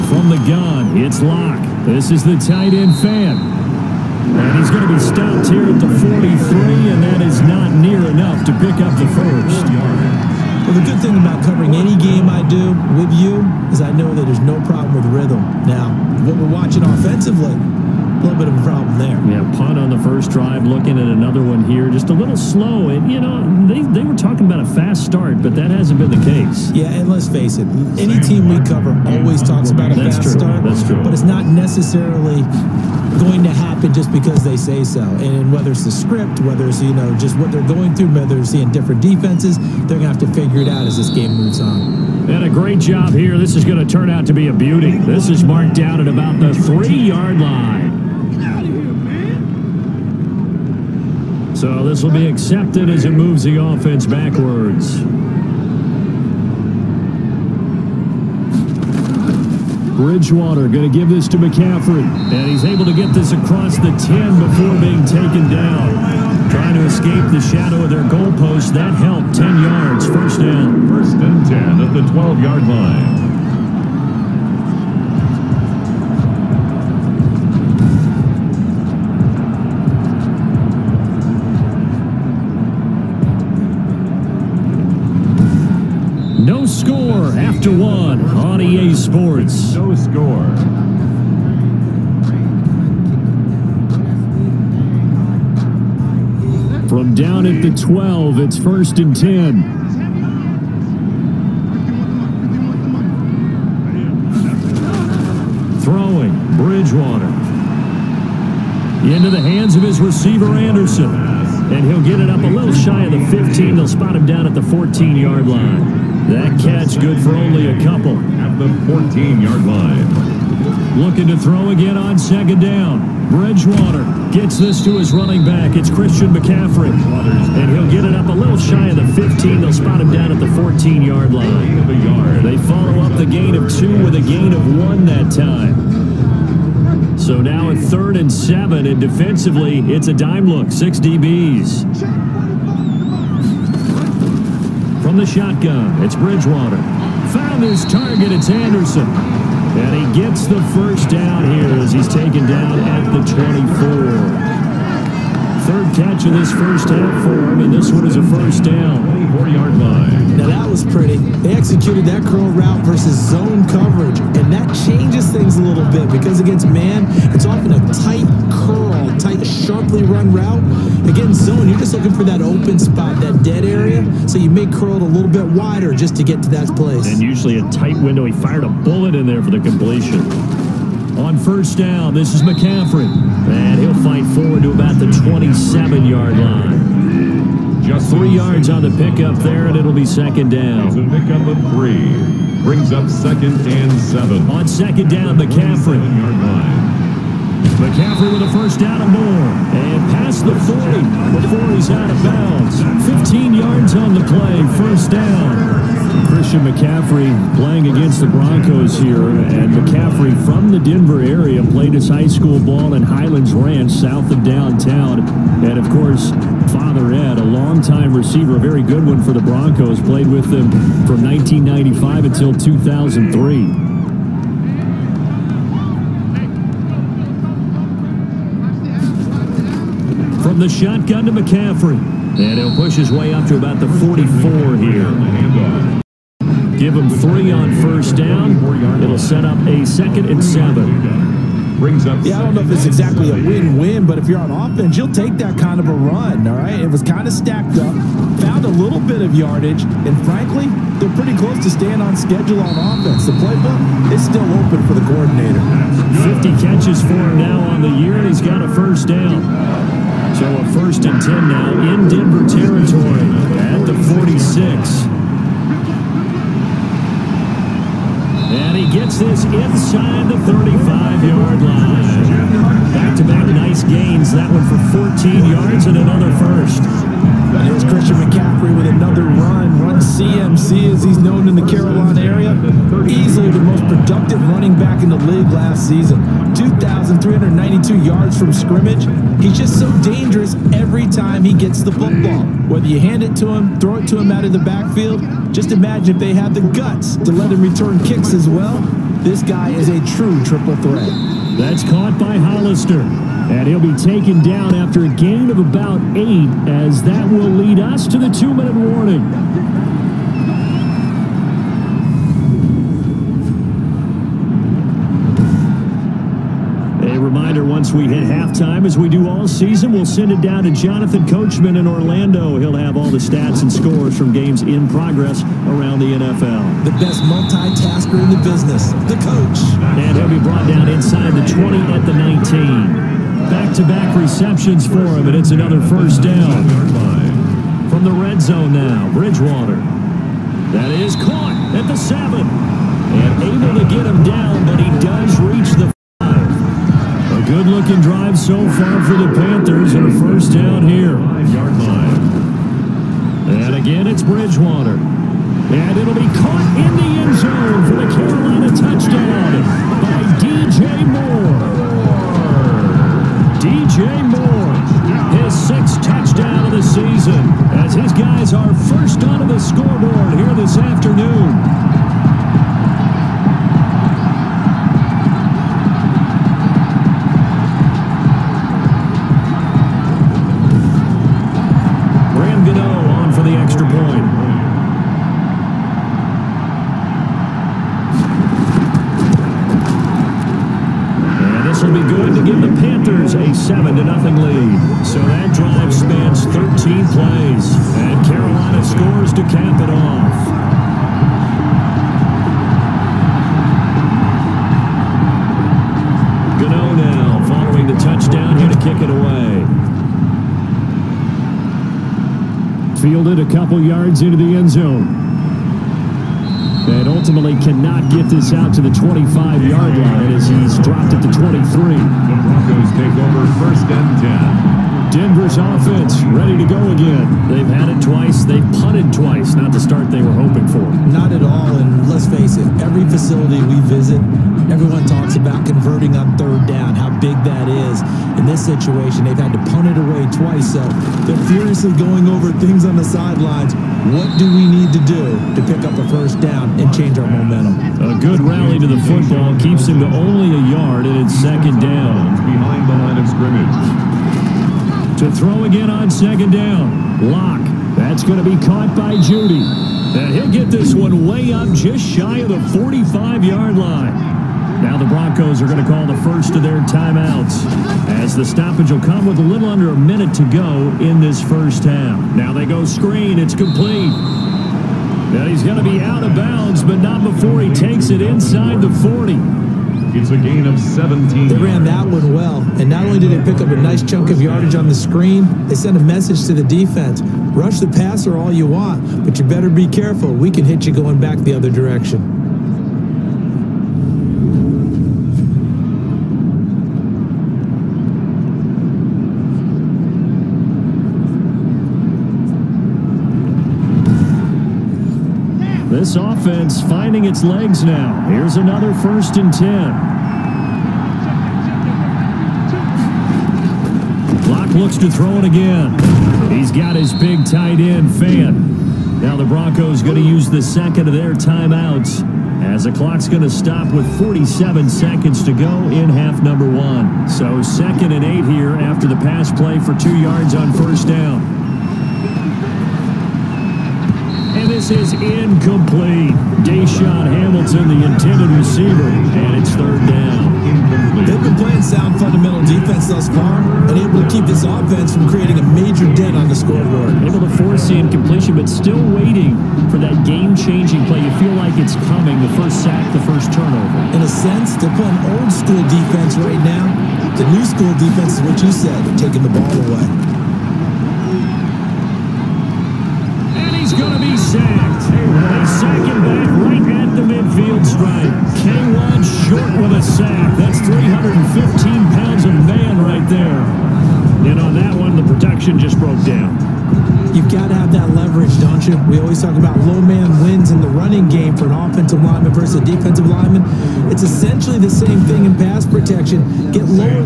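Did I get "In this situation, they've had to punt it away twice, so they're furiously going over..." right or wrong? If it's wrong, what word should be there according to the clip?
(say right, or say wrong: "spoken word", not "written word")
right.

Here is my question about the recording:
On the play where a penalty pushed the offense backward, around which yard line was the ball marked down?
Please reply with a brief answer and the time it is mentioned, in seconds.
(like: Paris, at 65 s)
3-yard line, at 46 s.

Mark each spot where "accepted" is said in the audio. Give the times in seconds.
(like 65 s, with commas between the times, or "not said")
52 s.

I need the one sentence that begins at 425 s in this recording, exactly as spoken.
Denver's offense ready to go again.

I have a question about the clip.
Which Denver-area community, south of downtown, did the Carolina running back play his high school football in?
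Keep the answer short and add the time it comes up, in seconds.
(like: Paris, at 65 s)
Highlands Ranch, at 213 s.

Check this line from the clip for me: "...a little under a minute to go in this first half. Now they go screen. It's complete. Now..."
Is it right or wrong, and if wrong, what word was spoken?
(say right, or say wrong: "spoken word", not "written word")
right.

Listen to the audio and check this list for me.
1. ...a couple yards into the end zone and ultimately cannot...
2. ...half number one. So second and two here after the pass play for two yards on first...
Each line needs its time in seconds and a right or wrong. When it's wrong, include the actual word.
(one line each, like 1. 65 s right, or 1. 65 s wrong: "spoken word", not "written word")
1. 413 s right
2. 526 s wrong: "eight", not "two".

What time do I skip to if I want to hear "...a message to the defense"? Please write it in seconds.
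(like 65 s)
485 s.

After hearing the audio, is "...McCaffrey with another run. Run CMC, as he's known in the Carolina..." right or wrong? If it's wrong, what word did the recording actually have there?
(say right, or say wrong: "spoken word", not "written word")
right.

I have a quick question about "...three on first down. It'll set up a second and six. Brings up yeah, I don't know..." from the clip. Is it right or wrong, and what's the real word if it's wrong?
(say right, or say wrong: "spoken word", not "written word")
wrong: "seven", not "six".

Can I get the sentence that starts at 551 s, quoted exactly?
You feel like it's coming, the first sack, the first turnover.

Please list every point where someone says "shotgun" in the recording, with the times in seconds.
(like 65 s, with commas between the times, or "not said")
145 s, 230 s.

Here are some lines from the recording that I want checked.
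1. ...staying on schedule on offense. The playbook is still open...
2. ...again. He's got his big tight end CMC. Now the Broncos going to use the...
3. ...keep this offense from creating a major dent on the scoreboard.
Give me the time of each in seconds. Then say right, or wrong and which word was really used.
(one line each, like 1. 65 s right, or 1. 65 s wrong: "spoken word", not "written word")
1. 251 s right
2. 515 s wrong: "Fant", not "CMC"
3. 544 s right.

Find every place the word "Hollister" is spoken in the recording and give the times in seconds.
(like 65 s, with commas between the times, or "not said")
302 s.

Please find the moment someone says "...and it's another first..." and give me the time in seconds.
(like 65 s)
335 s.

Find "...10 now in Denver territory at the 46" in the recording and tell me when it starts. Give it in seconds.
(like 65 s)
261 s.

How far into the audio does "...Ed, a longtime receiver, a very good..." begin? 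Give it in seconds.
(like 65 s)
217 s.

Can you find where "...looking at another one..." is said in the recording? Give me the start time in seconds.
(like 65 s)
20 s.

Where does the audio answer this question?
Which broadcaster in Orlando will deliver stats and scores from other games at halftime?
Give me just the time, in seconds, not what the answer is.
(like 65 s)
320 s.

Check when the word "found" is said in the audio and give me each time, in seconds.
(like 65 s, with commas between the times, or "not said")
147 s, 248 s.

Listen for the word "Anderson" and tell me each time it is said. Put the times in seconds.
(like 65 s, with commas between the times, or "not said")
110 s, 148 s.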